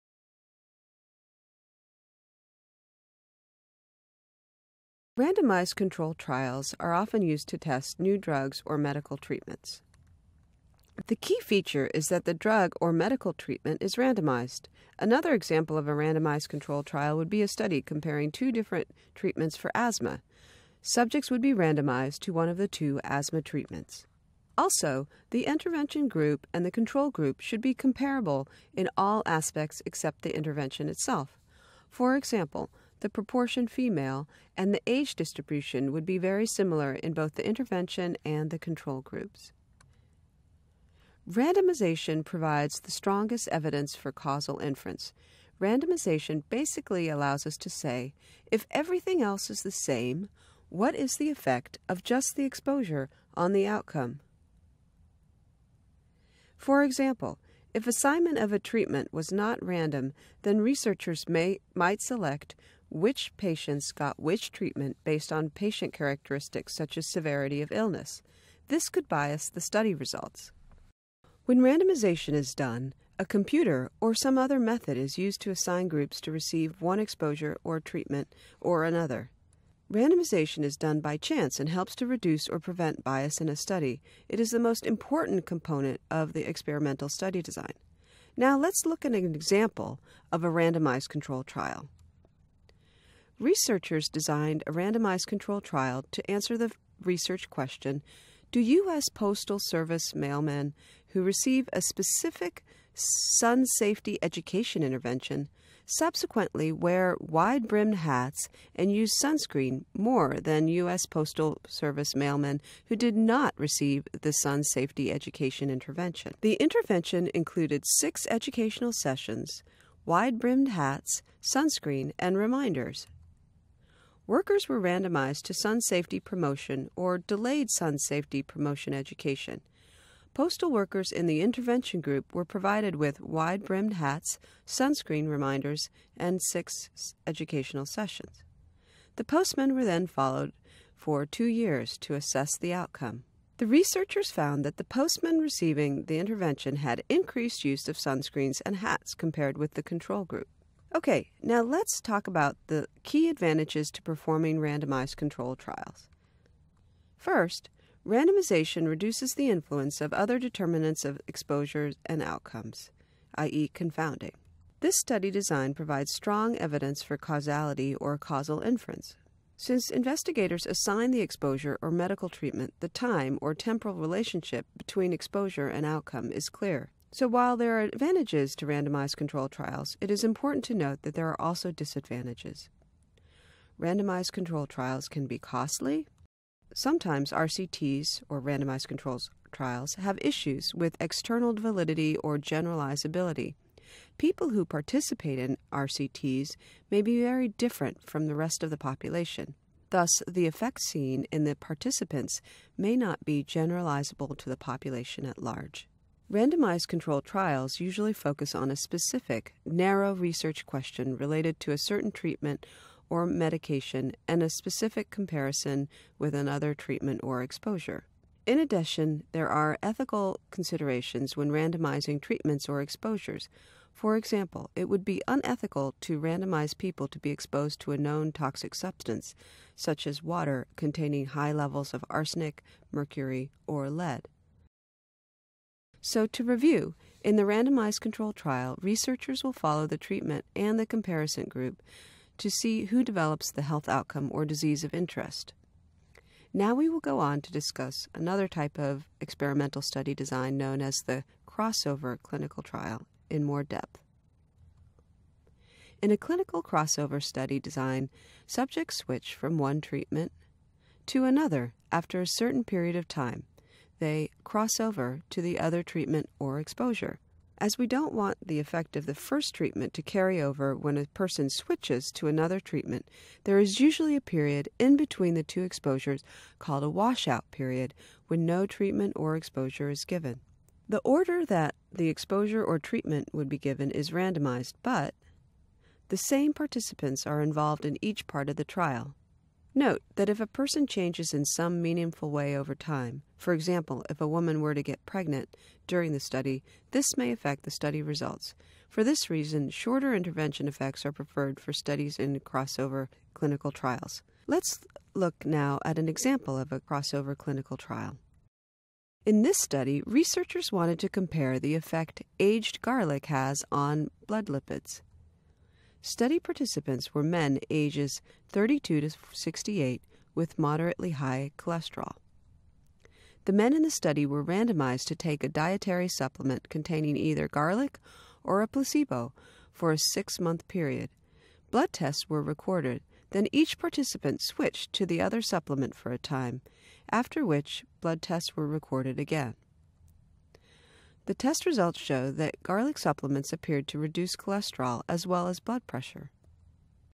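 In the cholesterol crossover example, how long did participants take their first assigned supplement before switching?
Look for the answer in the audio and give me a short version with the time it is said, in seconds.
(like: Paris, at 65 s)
6 months, at 329 s.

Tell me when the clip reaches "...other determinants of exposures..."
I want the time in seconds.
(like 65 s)
160 s.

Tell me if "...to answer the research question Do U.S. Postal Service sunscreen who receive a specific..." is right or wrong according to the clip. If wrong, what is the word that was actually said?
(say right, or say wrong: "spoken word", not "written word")
wrong: "mailmen", not "sunscreen".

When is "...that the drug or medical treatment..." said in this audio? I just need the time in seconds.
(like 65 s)
12 s.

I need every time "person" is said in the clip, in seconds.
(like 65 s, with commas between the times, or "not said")
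271 s, 290 s.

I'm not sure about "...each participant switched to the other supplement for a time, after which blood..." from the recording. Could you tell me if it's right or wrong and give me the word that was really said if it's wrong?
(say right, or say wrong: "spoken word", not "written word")
right.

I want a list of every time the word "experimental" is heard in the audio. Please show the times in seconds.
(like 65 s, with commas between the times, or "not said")
86 s, 249 s.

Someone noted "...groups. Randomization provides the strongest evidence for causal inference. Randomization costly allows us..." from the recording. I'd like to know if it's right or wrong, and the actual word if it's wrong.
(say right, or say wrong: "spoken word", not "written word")
wrong: "basically", not "costly".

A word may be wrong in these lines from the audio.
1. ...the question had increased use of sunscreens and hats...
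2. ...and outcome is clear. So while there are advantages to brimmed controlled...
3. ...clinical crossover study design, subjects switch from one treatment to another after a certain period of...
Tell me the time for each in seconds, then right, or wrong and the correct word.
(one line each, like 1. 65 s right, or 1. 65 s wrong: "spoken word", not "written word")
1. 146 s wrong: "intervention", not "question"
2. 175 s wrong: "randomized", not "brimmed"
3. 256 s right.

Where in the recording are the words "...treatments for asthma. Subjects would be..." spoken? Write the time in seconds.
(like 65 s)
19 s.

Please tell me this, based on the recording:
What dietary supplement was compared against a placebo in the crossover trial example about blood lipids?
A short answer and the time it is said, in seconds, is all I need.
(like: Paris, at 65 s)
aged garlic, at 312 s.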